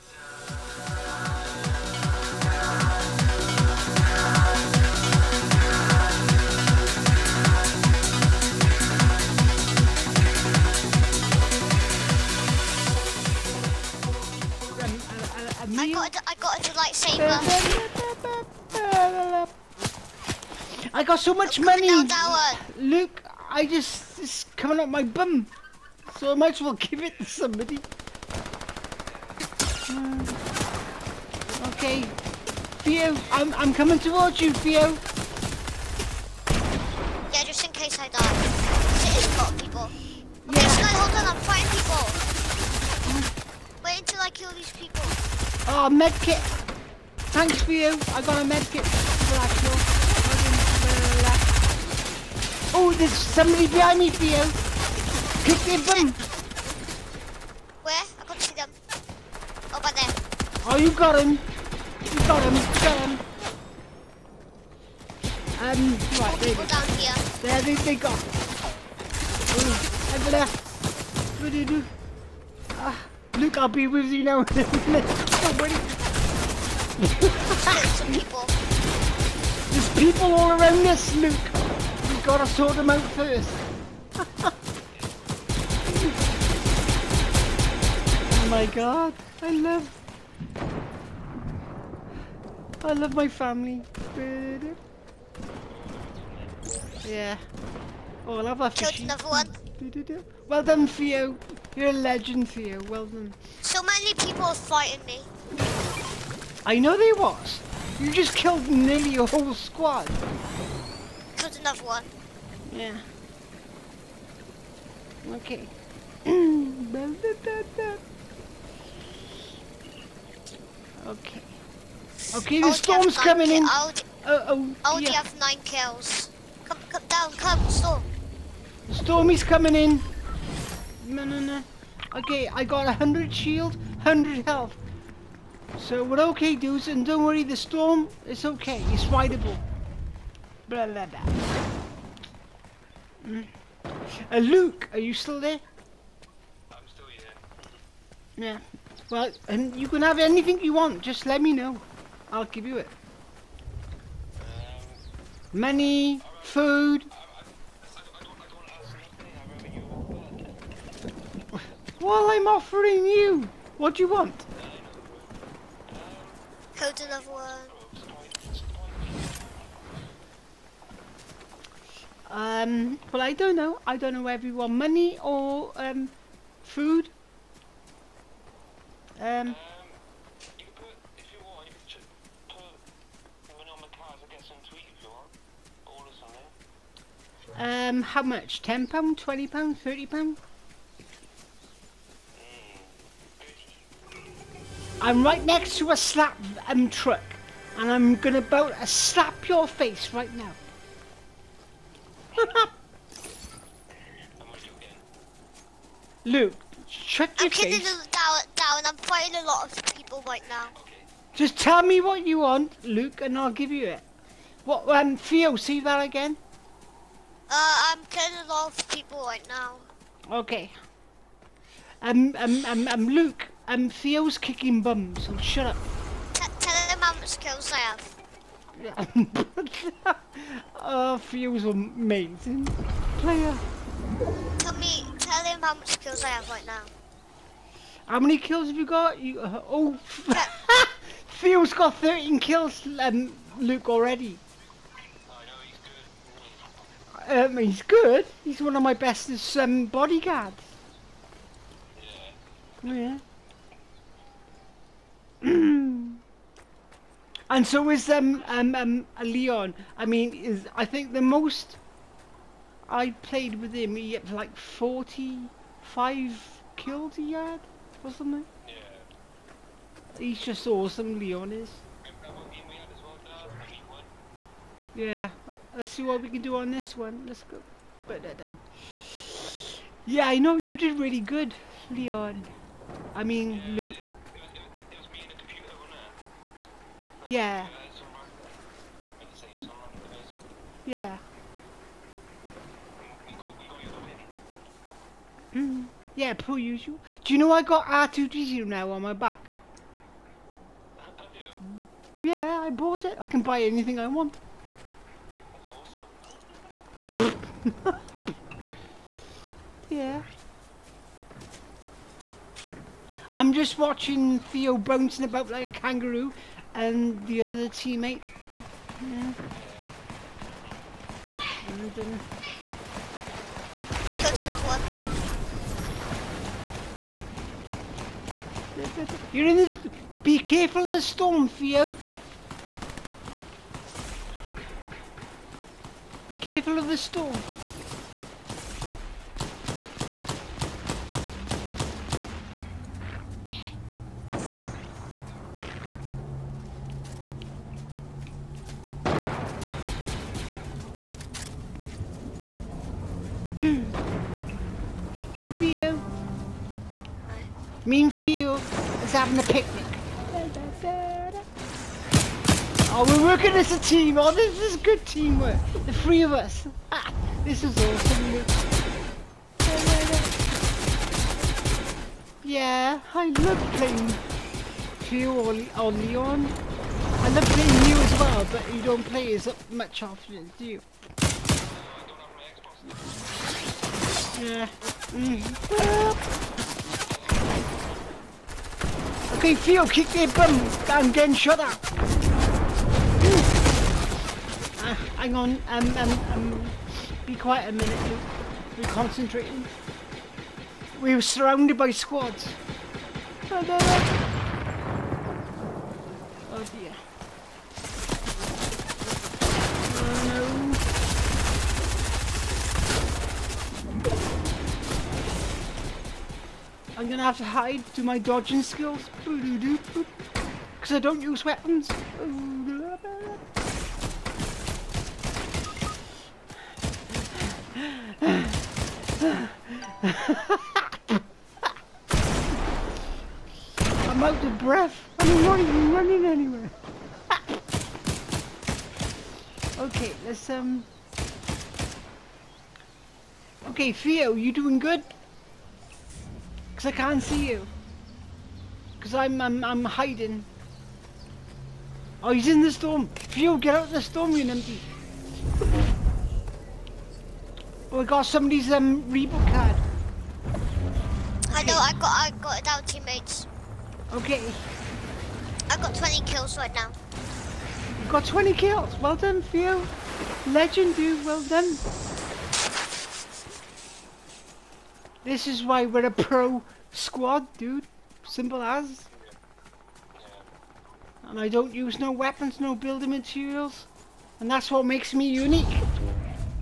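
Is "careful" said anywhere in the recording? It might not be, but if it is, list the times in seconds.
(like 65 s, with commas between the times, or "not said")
330 s, 336 s.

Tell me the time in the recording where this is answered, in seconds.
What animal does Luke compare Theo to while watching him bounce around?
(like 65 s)
315 s.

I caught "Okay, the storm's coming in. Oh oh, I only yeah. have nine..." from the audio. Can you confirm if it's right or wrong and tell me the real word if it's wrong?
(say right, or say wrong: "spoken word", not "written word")
right.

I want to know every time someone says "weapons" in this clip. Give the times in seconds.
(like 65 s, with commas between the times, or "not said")
421 s, 482 s.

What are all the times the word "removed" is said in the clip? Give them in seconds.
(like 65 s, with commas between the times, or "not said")
not said.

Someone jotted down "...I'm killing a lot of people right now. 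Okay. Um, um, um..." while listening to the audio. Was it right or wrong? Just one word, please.
right.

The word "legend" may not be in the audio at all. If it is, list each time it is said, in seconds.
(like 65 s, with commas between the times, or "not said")
101 s, 470 s.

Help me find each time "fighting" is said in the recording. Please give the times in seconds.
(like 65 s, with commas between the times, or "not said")
41 s, 104 s, 208 s.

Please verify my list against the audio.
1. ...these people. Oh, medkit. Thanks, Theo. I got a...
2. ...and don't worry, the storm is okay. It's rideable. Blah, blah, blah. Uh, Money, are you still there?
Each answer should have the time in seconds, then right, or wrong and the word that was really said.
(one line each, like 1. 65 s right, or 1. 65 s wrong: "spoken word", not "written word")
1. 44 s right
2. 136 s wrong: "Luke", not "Money".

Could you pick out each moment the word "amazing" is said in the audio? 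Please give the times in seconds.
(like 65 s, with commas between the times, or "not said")
231 s.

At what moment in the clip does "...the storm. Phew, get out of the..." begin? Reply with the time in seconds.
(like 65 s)
452 s.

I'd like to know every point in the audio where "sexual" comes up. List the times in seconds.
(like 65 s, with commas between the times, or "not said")
not said.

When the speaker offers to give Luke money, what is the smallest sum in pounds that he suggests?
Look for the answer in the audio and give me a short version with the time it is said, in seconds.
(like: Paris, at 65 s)
£10, at 188 s.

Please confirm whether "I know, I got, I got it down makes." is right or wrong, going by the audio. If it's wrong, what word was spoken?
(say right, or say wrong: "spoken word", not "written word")
wrong: "teammates", not "makes".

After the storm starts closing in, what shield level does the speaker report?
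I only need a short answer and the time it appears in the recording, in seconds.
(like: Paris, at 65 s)
100, at 132 s.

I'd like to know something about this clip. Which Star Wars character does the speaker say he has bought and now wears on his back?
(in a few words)
R2D2.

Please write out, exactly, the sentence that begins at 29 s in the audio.
Uh, okay, Theo, I'm I'm coming towards you, Theo.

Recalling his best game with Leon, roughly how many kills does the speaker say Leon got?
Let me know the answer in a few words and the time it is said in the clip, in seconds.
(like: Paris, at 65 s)
45, at 264 s.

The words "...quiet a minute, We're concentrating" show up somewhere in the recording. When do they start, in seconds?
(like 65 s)
397 s.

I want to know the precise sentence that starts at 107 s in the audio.
You just killed nearly your whole squad love one.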